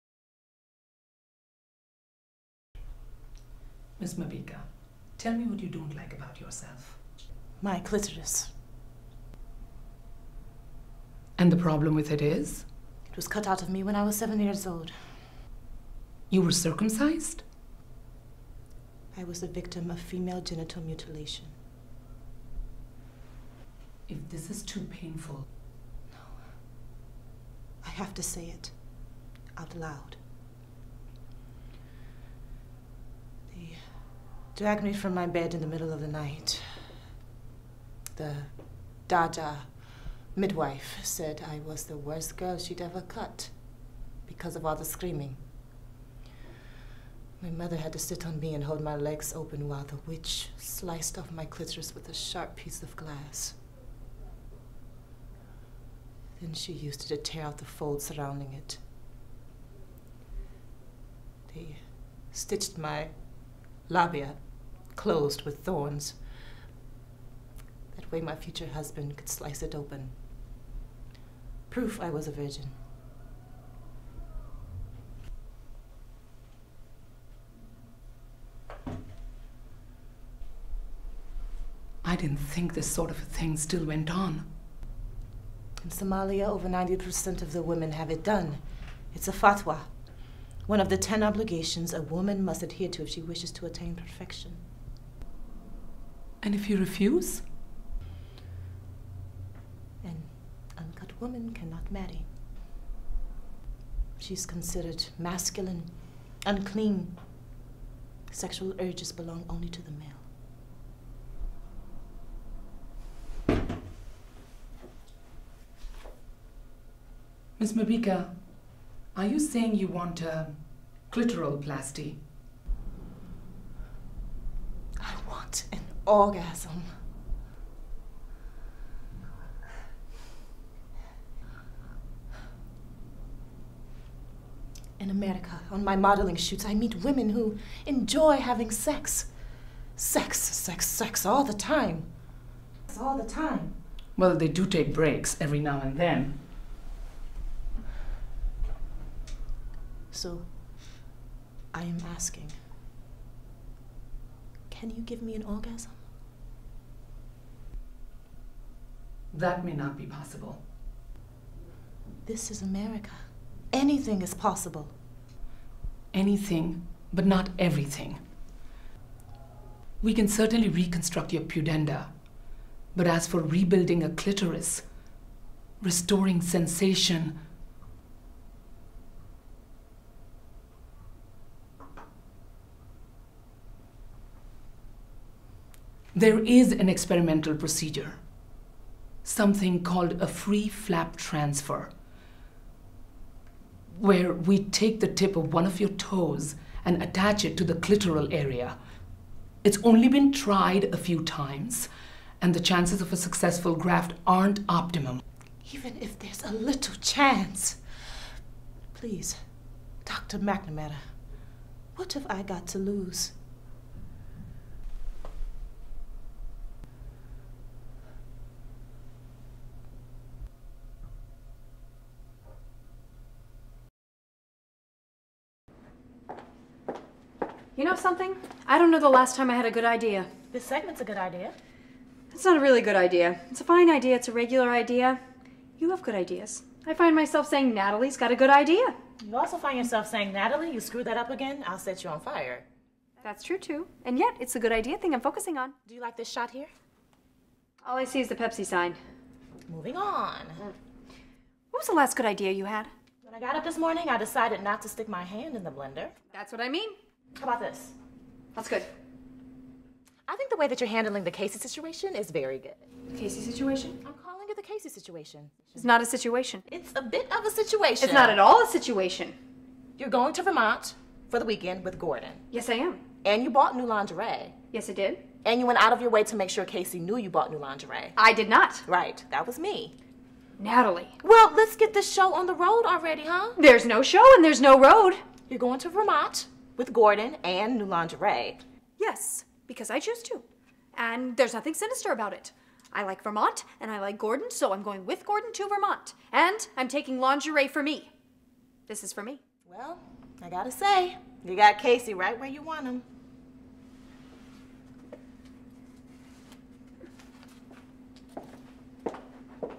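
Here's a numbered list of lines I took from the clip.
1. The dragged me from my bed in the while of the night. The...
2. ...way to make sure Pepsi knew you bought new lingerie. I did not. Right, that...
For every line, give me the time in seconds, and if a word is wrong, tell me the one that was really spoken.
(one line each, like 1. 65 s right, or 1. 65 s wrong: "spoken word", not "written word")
1. 33 s wrong: "middle", not "while"
2. 276 s wrong: "Casey", not "Pepsi".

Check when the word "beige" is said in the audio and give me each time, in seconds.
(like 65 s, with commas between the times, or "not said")
not said.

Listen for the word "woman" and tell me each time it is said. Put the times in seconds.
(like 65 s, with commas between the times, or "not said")
92 s, 101 s.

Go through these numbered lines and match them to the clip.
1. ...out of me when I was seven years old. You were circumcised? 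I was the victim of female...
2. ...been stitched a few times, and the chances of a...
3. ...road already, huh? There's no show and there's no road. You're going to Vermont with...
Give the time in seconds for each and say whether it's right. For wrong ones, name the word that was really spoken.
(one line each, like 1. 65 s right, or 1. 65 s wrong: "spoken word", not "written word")
1. 13 s right
2. 200 s wrong: "tried", not "stitched"
3. 282 s right.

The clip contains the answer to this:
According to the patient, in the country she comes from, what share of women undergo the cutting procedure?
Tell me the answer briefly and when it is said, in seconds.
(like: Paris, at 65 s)
over 90%, at 86 s.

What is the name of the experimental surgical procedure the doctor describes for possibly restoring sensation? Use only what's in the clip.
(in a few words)
free flap transfer.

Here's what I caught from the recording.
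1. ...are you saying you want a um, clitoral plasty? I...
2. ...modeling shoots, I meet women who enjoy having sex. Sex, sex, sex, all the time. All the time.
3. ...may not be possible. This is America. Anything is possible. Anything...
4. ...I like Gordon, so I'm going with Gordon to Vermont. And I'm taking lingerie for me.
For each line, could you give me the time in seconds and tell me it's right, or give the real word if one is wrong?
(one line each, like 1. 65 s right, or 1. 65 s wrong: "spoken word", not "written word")
1. 119 s right
2. 135 s right
3. 159 s right
4. 293 s right.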